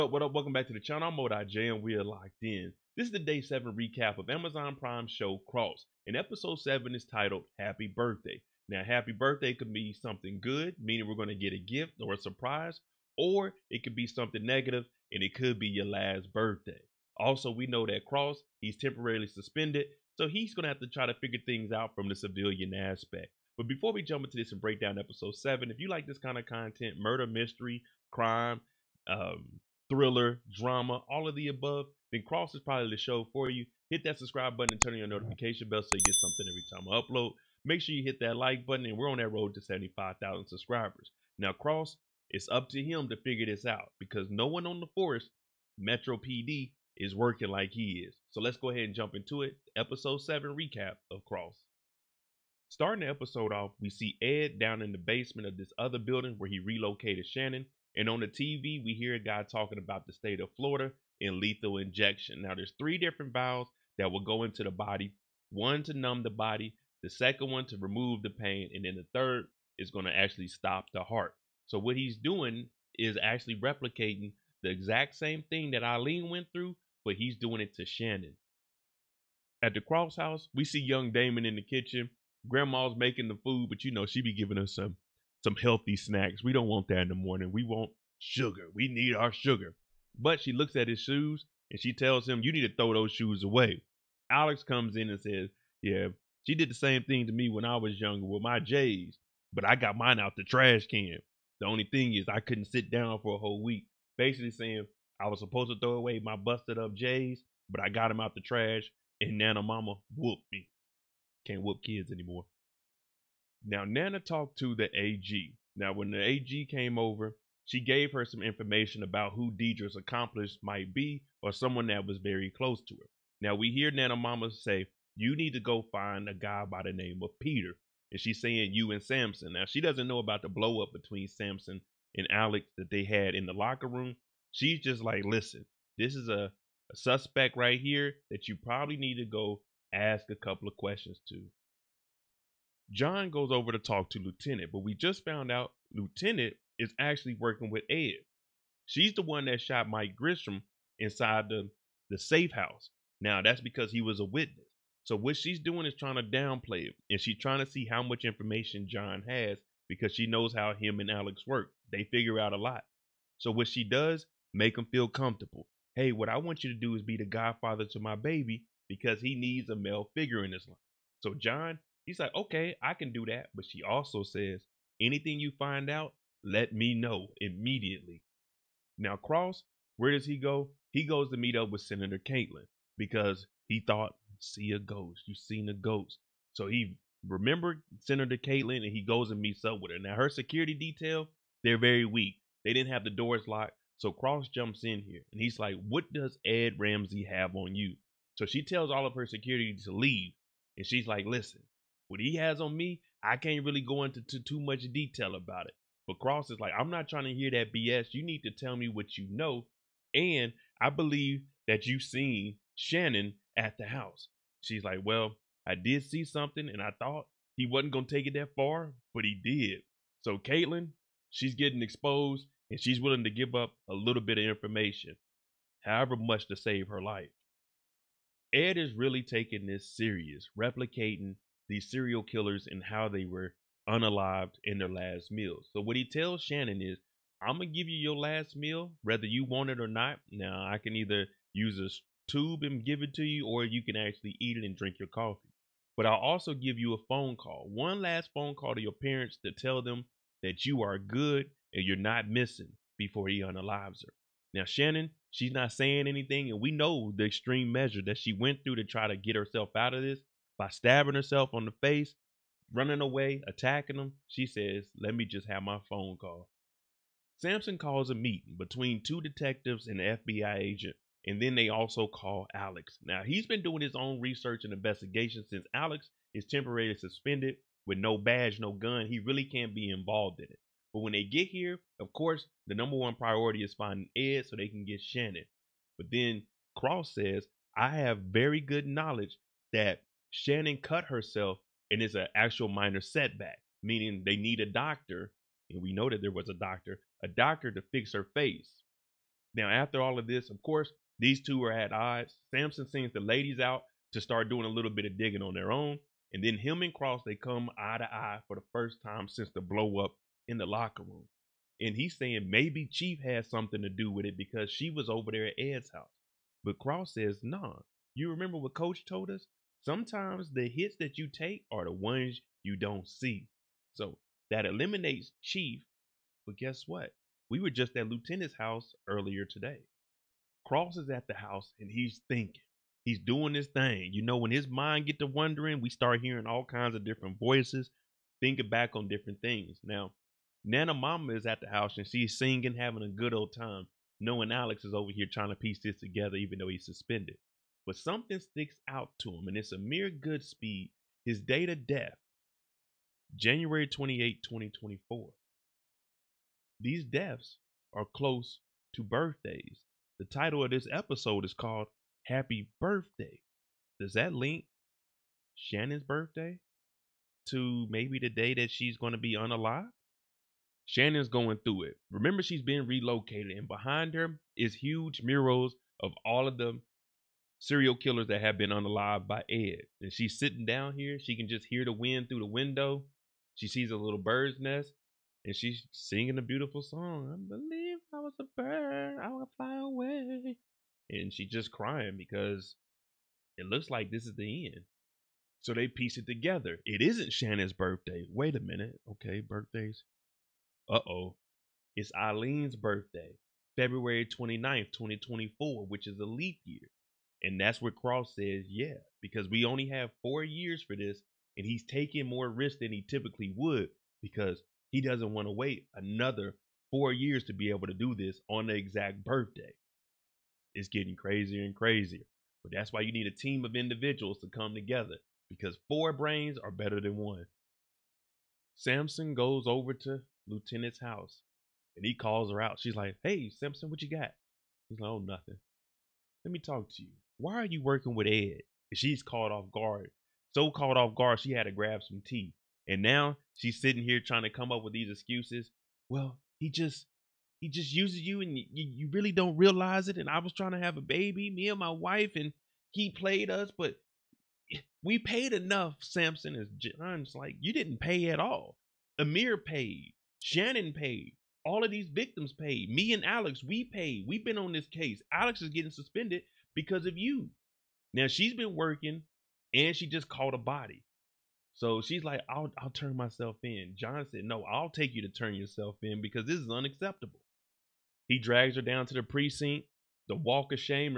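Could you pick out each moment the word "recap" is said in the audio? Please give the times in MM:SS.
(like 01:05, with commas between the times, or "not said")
00:03, 00:50.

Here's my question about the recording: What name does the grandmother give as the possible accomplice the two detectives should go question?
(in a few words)
Peter.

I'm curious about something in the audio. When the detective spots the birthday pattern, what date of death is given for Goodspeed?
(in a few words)
January 28, 2024.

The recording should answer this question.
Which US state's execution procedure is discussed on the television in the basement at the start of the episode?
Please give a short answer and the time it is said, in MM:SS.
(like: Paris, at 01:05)
Florida, at 01:00.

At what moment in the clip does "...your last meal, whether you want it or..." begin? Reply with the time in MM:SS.
03:57.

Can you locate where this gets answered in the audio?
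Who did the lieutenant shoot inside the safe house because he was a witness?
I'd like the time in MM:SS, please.
02:29.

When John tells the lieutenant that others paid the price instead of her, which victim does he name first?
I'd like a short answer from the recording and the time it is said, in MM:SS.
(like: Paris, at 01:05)
Amir, at 07:39.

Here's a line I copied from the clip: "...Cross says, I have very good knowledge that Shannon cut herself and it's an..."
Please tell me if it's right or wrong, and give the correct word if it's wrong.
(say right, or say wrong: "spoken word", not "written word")
right.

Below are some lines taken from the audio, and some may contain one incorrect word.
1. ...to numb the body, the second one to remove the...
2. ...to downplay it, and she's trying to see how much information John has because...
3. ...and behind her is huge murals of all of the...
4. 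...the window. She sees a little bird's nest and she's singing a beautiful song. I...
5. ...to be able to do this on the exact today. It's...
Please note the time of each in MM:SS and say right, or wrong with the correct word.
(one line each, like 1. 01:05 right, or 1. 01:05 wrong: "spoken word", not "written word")
1. 01:05 right
2. 02:36 right
3. 06:13 right
4. 06:22 right
5. 06:57 wrong: "birthday", not "today".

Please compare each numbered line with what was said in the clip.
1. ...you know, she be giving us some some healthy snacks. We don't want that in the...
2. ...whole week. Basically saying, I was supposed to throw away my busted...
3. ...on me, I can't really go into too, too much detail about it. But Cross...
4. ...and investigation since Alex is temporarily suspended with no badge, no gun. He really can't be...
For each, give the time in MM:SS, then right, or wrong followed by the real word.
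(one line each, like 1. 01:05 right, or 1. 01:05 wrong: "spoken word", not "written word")
1. 01:23 right
2. 01:43 right
3. 03:22 right
4. 04:34 right.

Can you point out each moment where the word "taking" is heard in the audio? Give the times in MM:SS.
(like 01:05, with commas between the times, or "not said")
03:49, 06:51.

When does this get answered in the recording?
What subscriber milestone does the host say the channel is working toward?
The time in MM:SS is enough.
00:39.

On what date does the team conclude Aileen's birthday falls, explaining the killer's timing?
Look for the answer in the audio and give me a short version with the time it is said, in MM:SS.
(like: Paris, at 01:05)
February 29th, 2024, at 06:43.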